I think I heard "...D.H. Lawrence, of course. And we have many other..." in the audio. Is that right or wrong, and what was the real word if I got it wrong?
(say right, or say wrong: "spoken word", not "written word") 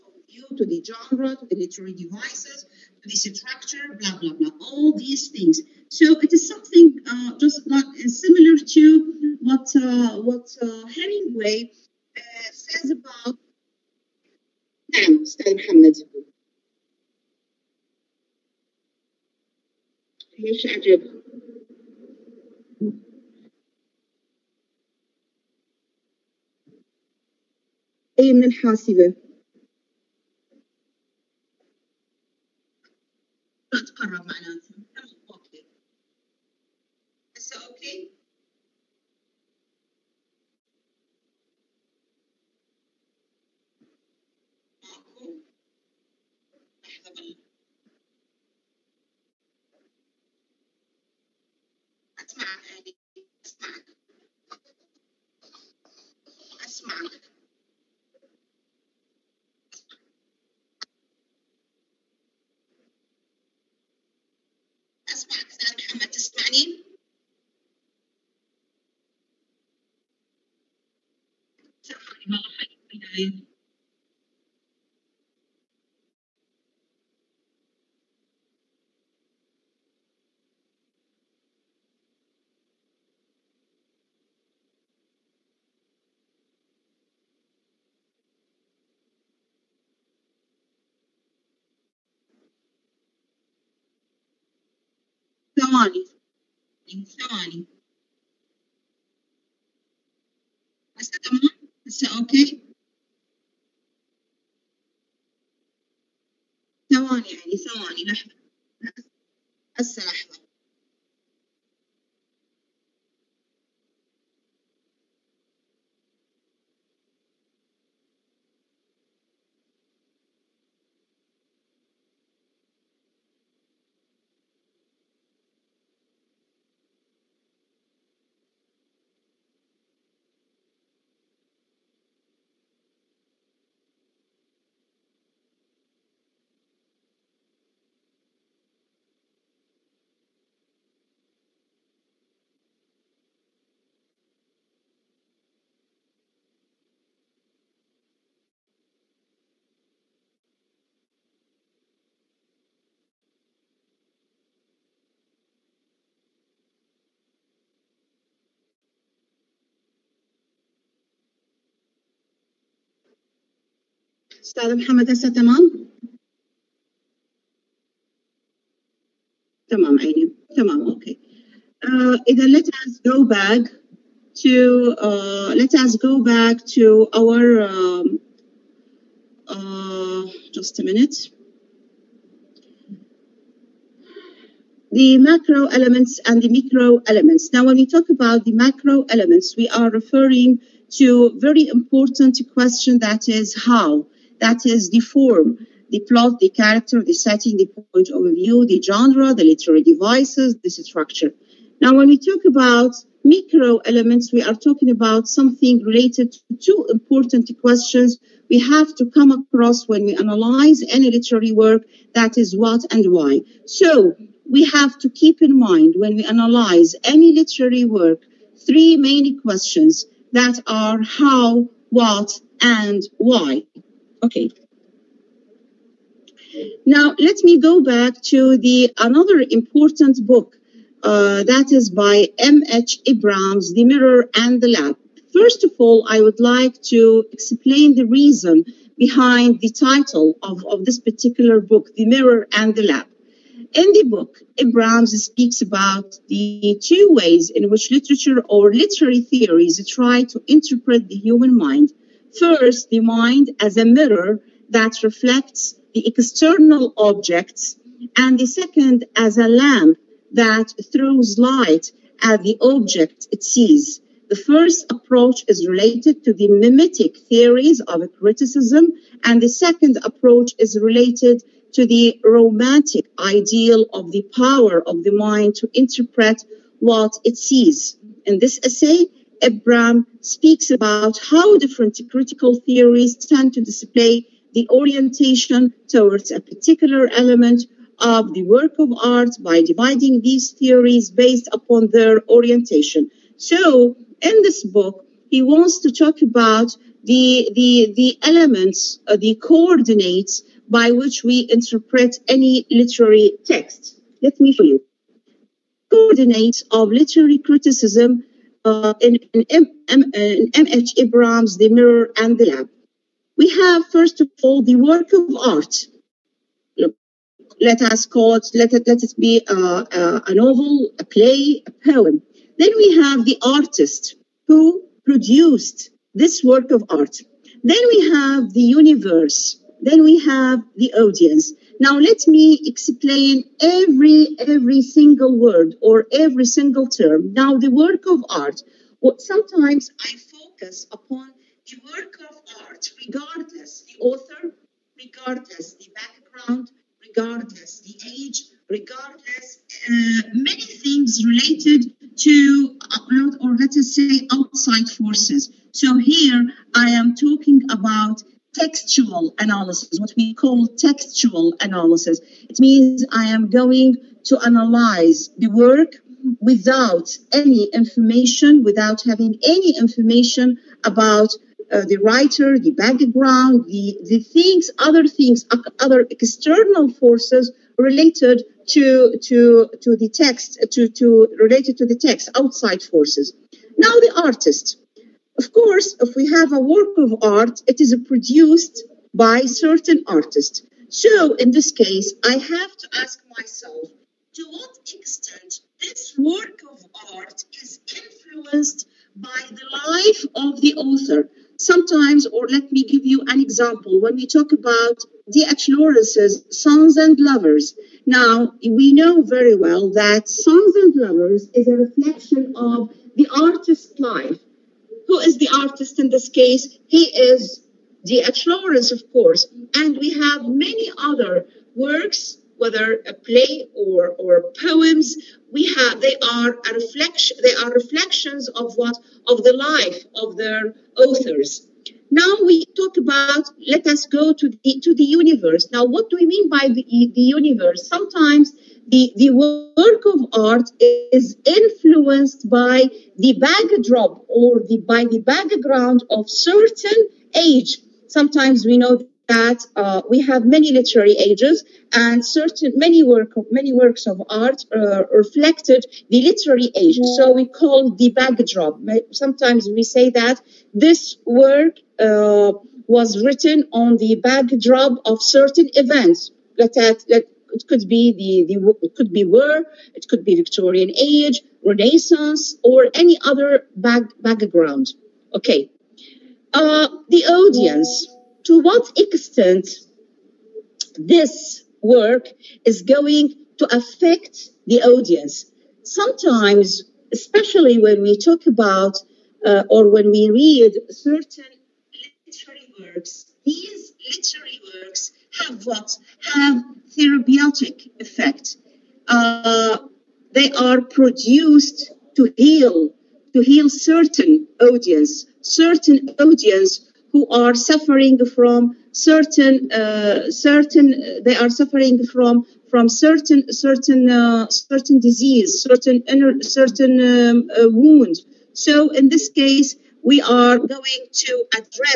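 right.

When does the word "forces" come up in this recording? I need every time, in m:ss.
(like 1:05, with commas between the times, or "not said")
5:54, 6:16, 6:22.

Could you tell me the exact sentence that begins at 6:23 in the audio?
Now the artist of course, if we have a work of art, it is produced by certain artists.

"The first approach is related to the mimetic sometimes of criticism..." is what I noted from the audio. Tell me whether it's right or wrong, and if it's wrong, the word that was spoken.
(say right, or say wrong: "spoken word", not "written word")
wrong: "theories", not "sometimes".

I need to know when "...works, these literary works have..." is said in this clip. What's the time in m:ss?
8:12.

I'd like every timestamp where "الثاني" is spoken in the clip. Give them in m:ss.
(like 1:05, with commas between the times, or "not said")
1:36.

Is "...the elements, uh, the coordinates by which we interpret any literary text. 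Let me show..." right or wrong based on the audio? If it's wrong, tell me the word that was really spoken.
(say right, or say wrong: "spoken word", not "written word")
right.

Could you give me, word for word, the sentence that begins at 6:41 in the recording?
Sometimes, or let me give you an example, when we talk about D.H.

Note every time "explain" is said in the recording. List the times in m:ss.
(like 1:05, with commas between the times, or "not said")
3:57, 5:32.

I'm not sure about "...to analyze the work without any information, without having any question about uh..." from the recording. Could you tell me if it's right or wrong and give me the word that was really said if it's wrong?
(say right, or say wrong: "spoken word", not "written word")
wrong: "information", not "question".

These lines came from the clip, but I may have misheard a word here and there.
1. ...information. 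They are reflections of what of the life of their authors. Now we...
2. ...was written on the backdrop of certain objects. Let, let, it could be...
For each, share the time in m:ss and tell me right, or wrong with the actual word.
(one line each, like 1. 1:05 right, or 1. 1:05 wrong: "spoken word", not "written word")
1. 7:06 wrong: "reflection", not "information"
2. 7:42 wrong: "events", not "objects".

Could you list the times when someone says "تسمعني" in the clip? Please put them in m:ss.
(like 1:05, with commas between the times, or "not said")
1:06.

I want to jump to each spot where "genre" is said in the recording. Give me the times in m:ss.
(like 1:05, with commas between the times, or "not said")
0:00, 3:18.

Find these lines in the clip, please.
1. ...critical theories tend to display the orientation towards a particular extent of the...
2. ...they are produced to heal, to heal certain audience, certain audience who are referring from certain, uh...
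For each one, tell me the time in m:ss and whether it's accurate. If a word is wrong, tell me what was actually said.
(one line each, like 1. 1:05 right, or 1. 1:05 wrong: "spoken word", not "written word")
1. 4:42 wrong: "element", not "extent"
2. 8:20 wrong: "suffering", not "referring".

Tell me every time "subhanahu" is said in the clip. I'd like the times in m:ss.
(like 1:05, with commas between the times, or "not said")
not said.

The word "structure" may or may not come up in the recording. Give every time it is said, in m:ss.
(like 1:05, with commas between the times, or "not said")
0:03, 3:20.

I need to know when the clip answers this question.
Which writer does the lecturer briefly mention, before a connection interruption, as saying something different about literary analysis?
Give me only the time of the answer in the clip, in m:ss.
0:10.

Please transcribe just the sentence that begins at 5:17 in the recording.
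Let us call it, let it, let it be a, uh, a, uh, a novel, a play, a poem.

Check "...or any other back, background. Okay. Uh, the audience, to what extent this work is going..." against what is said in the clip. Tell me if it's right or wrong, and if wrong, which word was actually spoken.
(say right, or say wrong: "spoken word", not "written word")
right.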